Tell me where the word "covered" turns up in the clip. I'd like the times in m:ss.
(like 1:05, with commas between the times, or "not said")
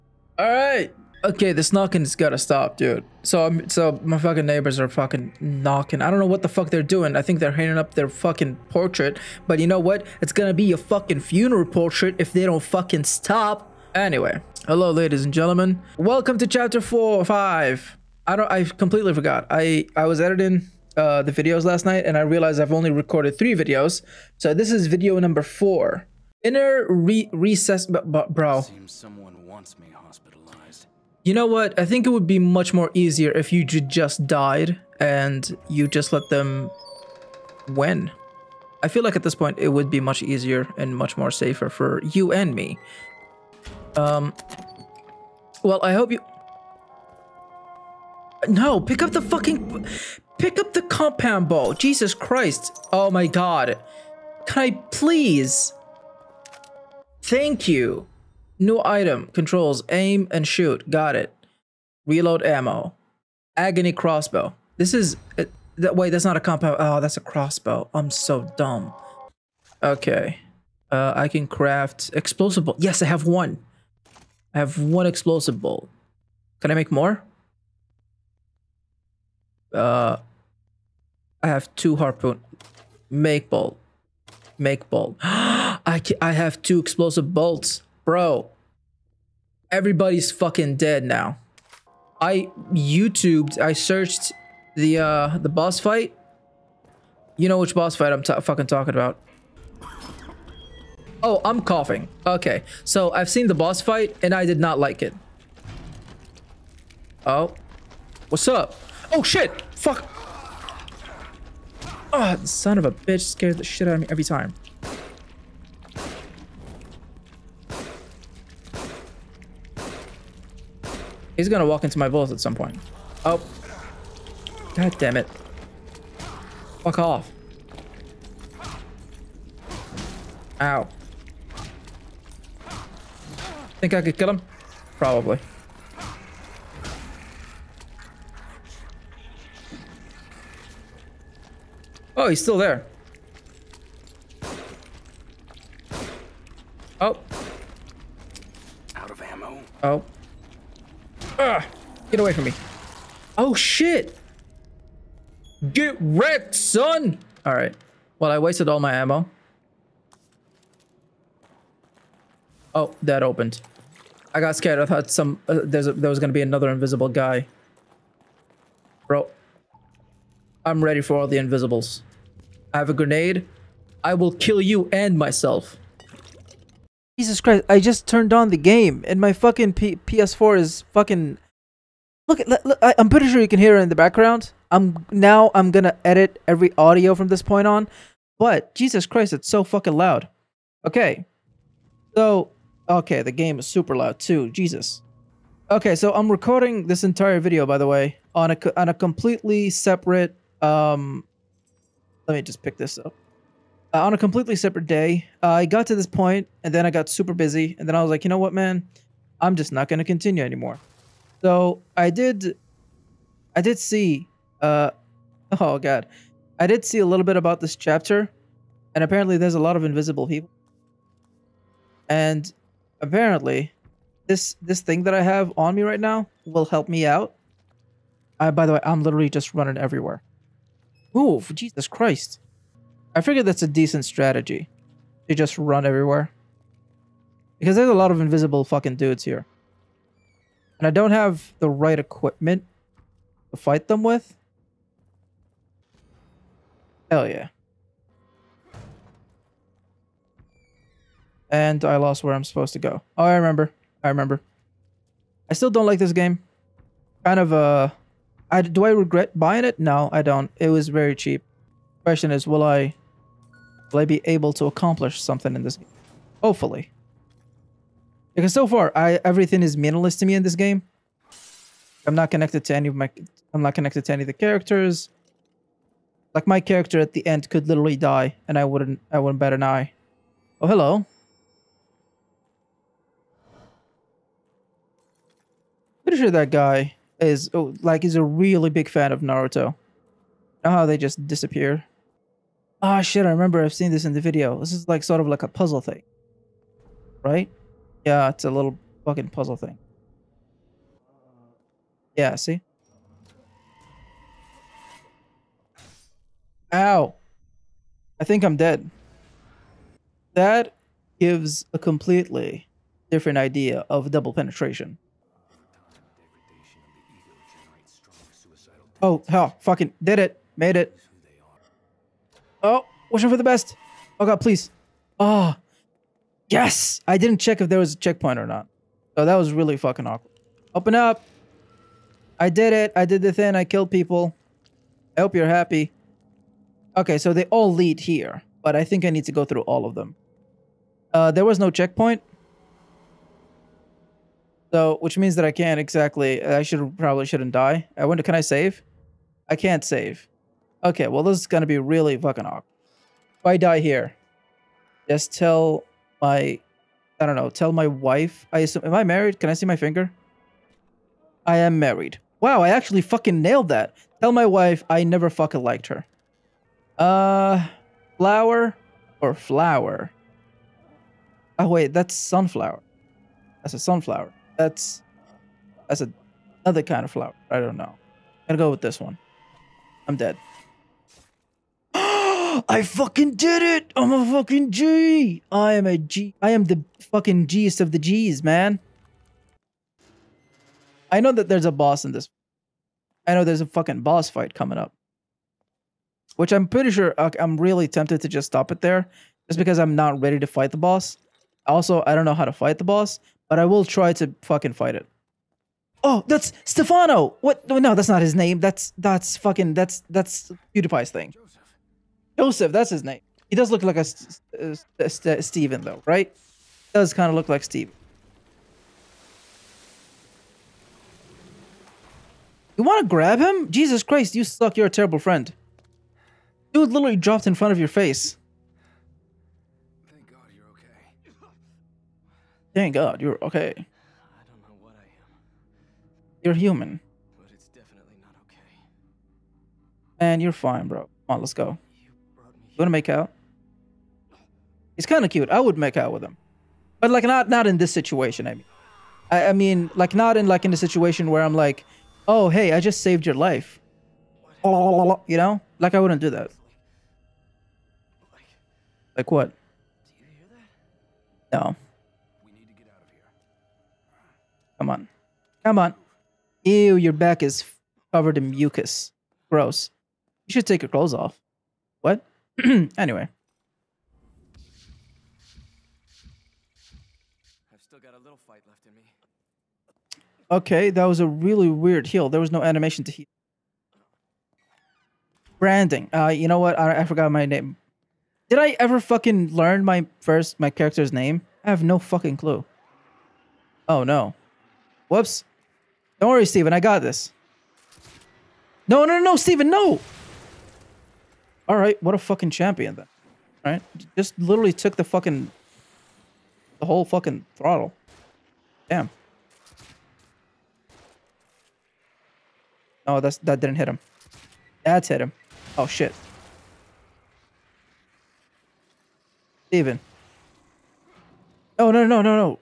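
7:48.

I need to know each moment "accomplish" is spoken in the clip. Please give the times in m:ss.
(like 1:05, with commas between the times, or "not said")
4:24.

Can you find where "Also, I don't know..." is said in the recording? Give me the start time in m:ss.
6:41.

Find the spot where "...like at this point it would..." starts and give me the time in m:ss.
0:39.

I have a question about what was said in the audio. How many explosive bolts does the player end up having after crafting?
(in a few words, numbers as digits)
2.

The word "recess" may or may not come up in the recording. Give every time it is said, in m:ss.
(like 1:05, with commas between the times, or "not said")
0:27.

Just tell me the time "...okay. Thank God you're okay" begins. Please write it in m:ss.
7:10.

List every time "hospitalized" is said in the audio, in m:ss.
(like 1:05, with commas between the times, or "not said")
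0:29.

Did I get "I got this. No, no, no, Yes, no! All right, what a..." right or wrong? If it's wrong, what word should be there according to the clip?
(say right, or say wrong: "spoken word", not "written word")
wrong: "Steven", not "Yes".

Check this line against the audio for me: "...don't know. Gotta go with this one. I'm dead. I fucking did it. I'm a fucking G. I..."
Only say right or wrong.
right.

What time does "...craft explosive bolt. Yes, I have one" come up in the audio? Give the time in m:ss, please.
1:11.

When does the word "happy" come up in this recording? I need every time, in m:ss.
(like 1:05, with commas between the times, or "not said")
5:35.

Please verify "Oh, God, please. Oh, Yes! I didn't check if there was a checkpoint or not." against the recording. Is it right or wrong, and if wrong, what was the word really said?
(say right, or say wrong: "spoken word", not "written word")
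right.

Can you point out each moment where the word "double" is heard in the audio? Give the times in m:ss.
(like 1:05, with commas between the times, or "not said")
5:14.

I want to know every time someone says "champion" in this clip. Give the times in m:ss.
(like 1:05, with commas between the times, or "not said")
8:22.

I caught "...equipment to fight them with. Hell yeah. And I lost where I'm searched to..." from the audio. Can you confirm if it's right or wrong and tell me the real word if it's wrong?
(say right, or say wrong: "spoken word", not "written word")
wrong: "supposed", not "searched".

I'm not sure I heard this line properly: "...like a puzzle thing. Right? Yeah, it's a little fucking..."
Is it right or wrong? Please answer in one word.
right.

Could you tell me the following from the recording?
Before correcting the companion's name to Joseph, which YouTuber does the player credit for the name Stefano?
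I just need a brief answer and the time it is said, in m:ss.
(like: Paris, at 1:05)
PewDiePie, at 6:50.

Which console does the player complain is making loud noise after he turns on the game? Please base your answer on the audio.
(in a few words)
PS4.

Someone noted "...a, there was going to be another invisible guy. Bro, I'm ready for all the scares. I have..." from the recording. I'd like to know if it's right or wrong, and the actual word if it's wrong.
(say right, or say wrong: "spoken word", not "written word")
wrong: "invisibles", not "scares".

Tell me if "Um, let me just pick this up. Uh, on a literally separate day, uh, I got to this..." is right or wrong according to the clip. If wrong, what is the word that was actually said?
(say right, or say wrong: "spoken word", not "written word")
wrong: "completely", not "literally".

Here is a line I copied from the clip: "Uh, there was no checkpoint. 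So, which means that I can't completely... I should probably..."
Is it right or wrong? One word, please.
wrong.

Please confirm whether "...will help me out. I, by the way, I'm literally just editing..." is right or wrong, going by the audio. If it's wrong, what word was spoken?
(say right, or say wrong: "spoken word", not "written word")
wrong: "running", not "editing".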